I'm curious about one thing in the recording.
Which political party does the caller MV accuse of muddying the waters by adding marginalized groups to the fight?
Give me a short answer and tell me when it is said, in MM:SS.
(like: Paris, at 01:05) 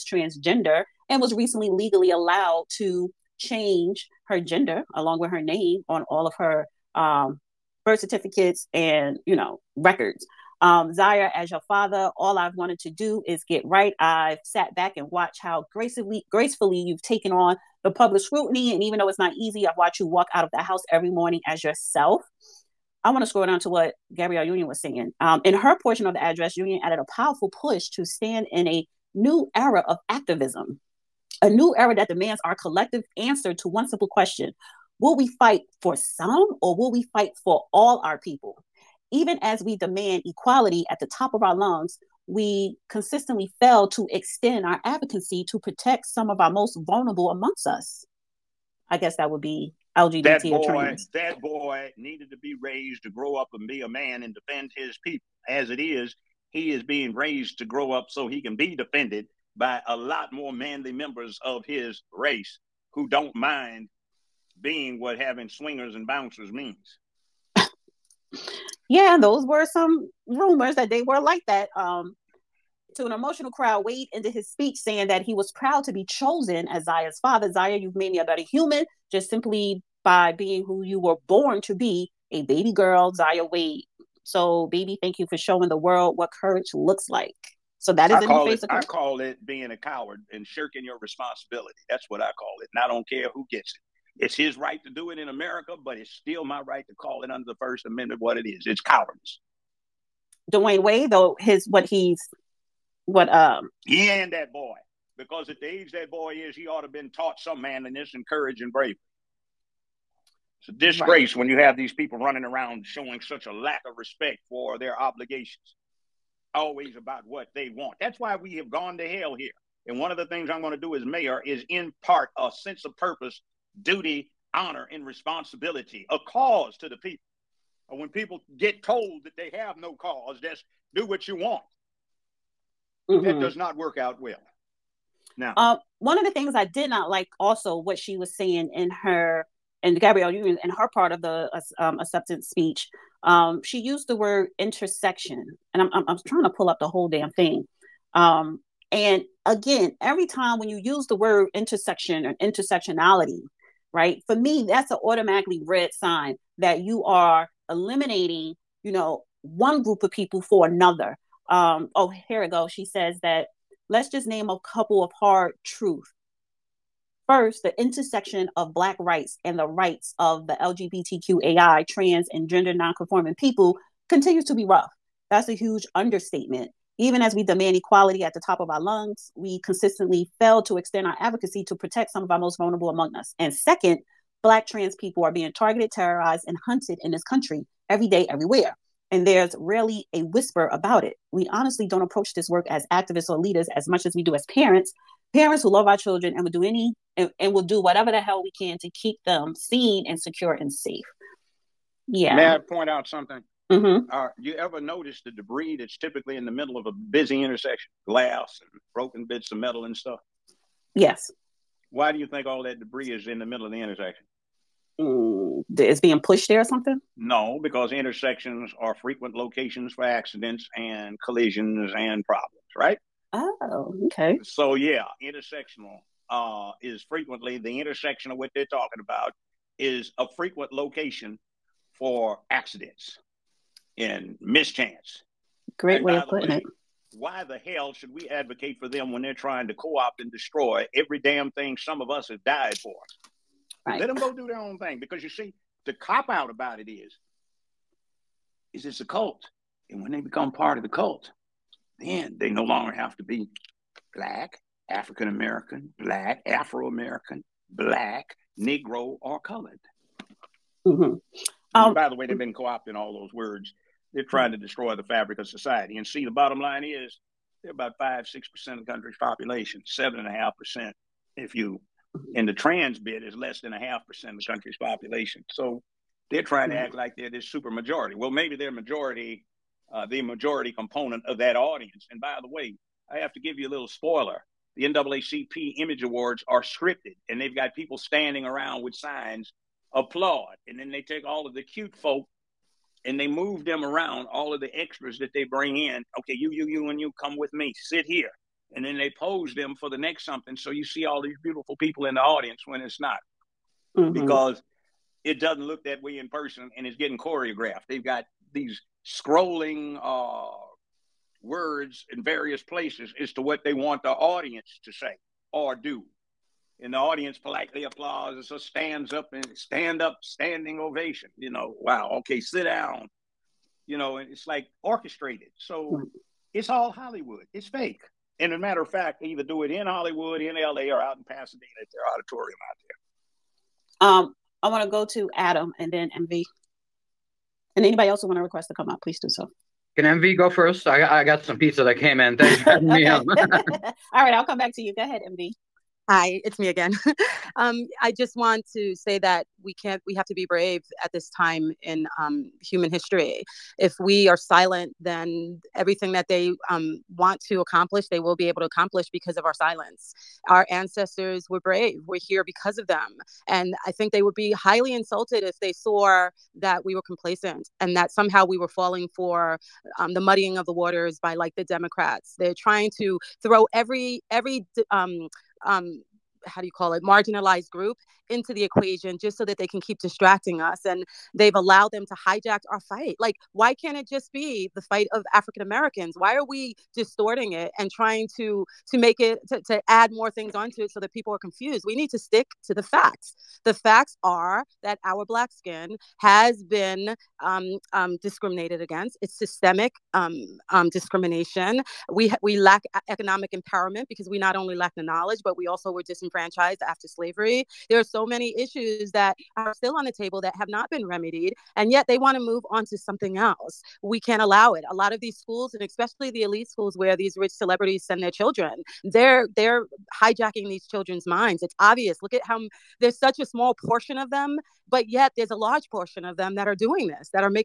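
the Democrats, at 06:11.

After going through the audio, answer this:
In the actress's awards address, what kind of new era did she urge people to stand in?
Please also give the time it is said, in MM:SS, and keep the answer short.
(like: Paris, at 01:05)
activism, at 00:30.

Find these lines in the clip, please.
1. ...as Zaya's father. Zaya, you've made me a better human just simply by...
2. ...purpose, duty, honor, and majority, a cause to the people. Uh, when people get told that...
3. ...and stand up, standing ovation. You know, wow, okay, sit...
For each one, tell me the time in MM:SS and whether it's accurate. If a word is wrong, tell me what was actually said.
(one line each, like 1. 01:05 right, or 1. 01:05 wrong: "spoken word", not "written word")
1. 01:16 right
2. 02:02 wrong: "responsibility", not "majority"
3. 05:19 right.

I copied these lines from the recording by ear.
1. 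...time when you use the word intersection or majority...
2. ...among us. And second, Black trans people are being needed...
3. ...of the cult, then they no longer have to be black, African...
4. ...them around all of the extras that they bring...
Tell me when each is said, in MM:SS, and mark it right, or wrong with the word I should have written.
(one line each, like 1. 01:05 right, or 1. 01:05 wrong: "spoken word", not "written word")
1. 02:30 wrong: "intersectionality", not "majority"
2. 03:02 wrong: "targeted", not "needed"
3. 04:10 right
4. 04:53 right.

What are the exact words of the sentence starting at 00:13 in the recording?
I've sat back and watched how gracefully, gracefully you've taken on the public scrutiny.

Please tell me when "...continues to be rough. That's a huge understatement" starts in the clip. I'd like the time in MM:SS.
02:54.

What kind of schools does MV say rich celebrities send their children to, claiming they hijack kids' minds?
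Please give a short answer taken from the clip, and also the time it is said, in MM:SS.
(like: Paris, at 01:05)
elite schools, at 06:56.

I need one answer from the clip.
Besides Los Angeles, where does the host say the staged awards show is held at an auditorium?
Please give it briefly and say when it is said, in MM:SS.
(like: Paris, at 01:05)
Pasadena, at 05:31.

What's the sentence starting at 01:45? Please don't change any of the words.
Because at the age that boy is, he ought to have been taught some manliness and courage and bravery.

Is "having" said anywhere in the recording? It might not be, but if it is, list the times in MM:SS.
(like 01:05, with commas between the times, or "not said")
01:05, 05:42.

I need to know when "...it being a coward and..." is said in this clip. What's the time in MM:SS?
01:29.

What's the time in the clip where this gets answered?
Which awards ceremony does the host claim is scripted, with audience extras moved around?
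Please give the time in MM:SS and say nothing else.
04:44.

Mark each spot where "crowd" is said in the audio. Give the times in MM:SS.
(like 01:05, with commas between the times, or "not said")
01:13.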